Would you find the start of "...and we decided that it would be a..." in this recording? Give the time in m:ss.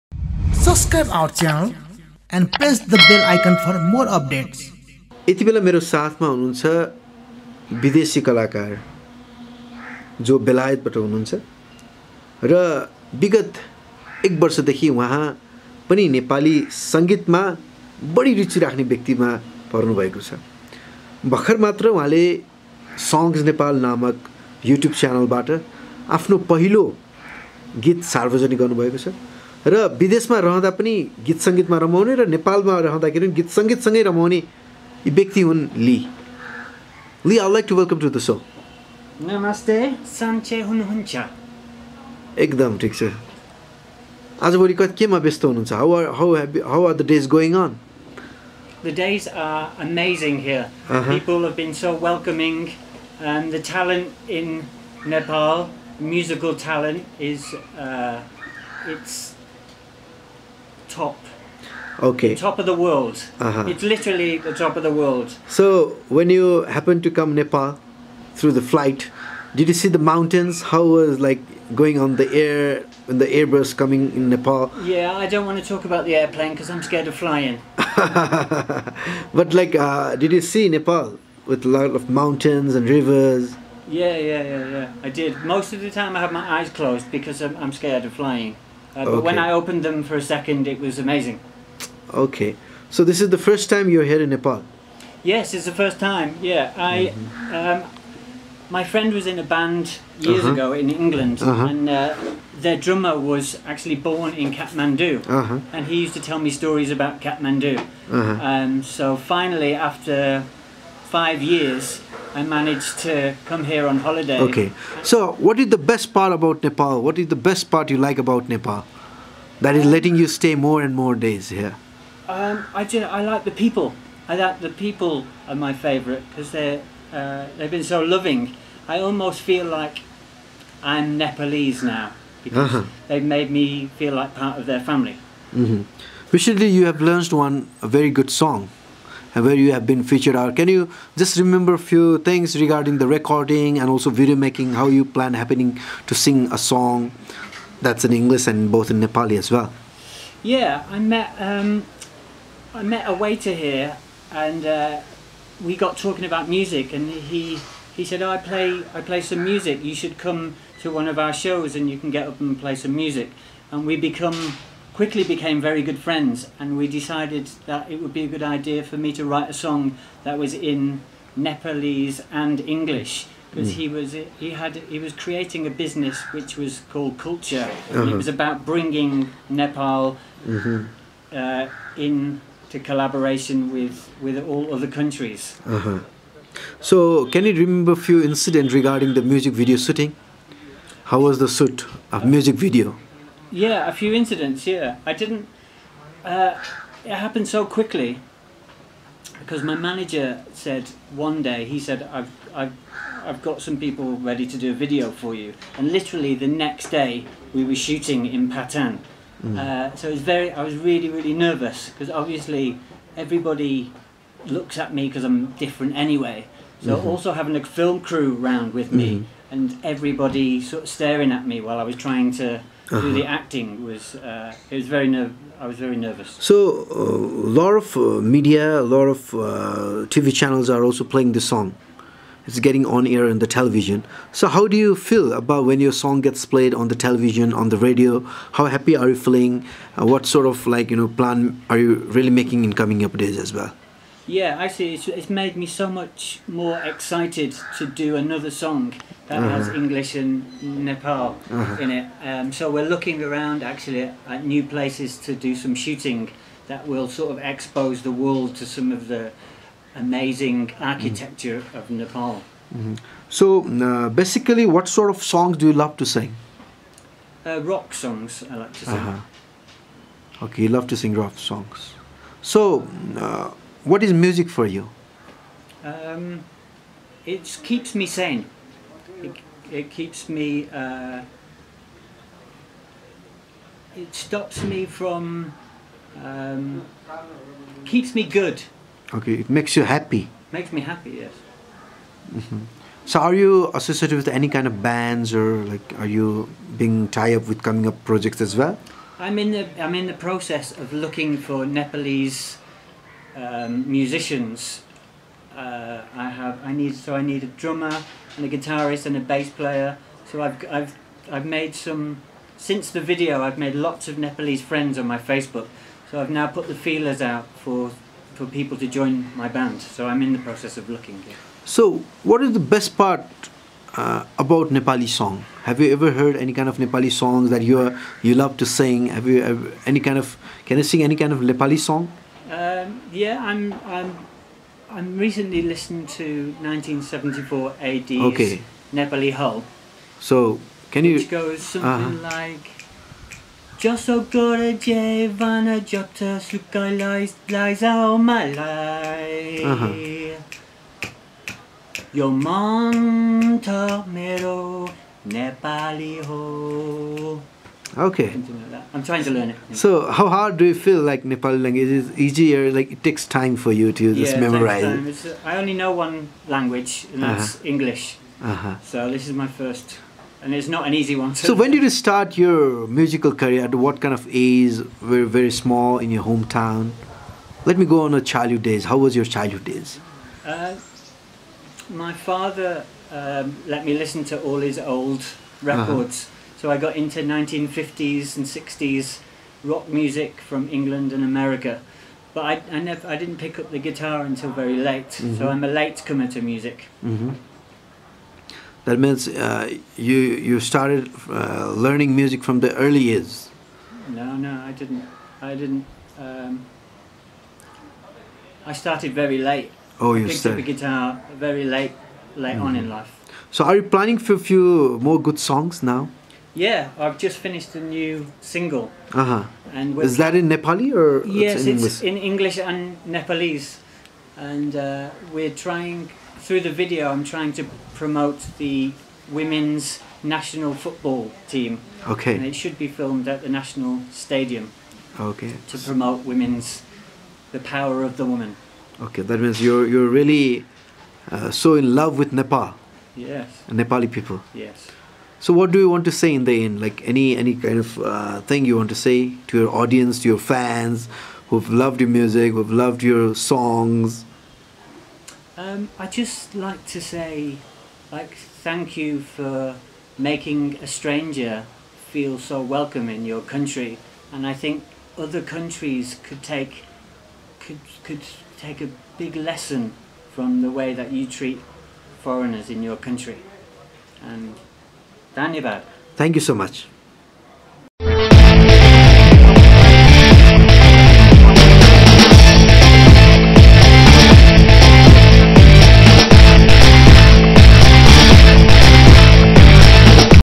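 2:46.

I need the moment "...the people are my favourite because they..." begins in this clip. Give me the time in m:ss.
2:04.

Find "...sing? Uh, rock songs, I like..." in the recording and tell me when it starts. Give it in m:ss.
4:26.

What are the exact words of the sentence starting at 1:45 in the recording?
and he used to tell me stories about Kathmandu.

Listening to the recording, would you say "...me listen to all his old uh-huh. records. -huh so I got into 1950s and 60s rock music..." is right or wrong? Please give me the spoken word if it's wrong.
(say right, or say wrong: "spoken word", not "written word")
right.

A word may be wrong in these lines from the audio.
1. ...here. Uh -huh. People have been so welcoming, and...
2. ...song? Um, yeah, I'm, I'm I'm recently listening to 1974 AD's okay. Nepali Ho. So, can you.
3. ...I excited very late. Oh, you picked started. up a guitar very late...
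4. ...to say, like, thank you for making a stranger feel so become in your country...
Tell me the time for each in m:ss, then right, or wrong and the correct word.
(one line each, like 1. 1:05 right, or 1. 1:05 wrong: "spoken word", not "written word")
1. 0:50 right
2. 5:31 right
3. 6:48 wrong: "started", not "excited"
4. 7:36 wrong: "welcome", not "become".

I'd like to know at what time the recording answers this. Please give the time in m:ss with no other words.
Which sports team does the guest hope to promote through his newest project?
7:09.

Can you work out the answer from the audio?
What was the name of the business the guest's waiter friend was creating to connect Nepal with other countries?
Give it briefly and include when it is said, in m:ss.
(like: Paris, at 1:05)
Culture, at 2:57.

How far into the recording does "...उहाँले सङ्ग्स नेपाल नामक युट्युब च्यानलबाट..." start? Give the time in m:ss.
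0:21.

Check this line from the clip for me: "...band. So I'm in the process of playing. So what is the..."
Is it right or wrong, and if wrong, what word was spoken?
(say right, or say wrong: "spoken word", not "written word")
wrong: "looking", not "playing".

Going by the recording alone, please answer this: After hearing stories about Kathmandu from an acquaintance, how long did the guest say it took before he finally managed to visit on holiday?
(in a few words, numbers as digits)
5 years.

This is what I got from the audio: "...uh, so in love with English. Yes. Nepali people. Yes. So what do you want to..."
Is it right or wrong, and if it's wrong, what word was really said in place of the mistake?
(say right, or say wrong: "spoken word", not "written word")
wrong: "Nepal", not "English".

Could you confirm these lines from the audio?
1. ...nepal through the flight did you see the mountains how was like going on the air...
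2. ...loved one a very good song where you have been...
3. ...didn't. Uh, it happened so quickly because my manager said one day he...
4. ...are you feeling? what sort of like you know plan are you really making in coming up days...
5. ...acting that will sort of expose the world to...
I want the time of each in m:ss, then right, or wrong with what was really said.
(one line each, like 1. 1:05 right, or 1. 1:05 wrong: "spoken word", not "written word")
1. 1:07 right
2. 2:17 wrong: "learned", not "loved"
3. 3:15 right
4. 3:58 right
5. 4:15 wrong: "shooting", not "acting".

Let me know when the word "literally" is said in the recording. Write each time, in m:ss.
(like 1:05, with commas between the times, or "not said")
1:03, 3:25.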